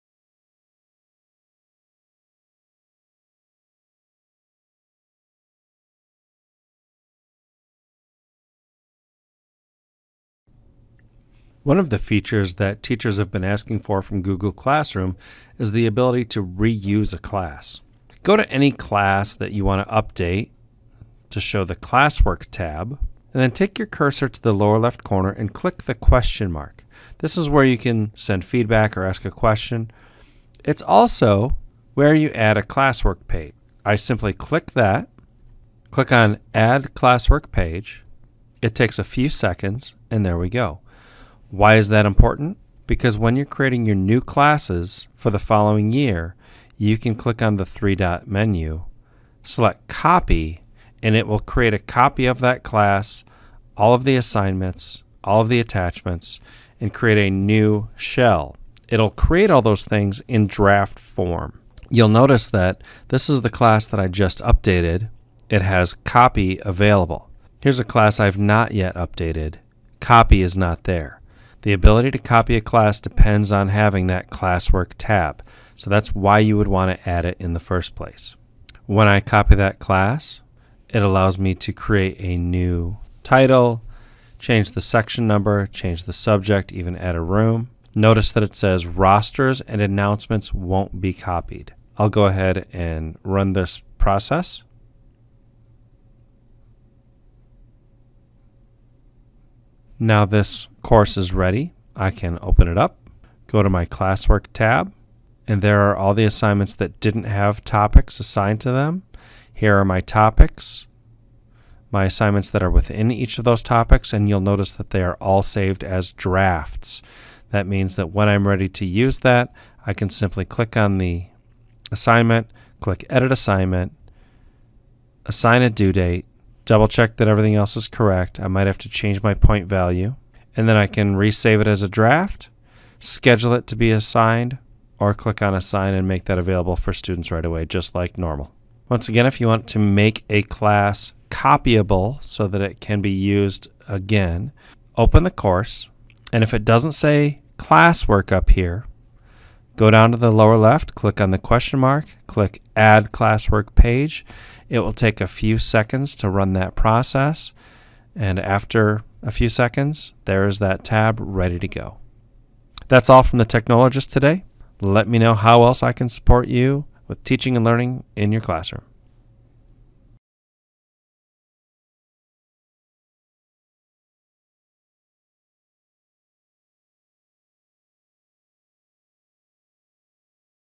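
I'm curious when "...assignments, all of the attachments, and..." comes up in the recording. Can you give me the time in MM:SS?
00:54.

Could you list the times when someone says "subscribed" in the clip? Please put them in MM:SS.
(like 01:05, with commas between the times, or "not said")
not said.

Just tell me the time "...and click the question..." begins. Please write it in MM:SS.
00:25.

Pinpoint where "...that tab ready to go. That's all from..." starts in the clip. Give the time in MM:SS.
02:40.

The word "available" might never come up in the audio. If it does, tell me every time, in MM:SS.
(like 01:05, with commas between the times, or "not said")
01:06, 02:16.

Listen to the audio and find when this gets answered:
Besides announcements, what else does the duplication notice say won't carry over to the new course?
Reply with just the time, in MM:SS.
01:28.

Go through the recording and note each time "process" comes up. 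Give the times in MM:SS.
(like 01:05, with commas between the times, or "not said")
01:33, 02:36.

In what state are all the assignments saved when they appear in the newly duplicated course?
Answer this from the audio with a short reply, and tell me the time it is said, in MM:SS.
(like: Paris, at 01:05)
drafts, at 01:56.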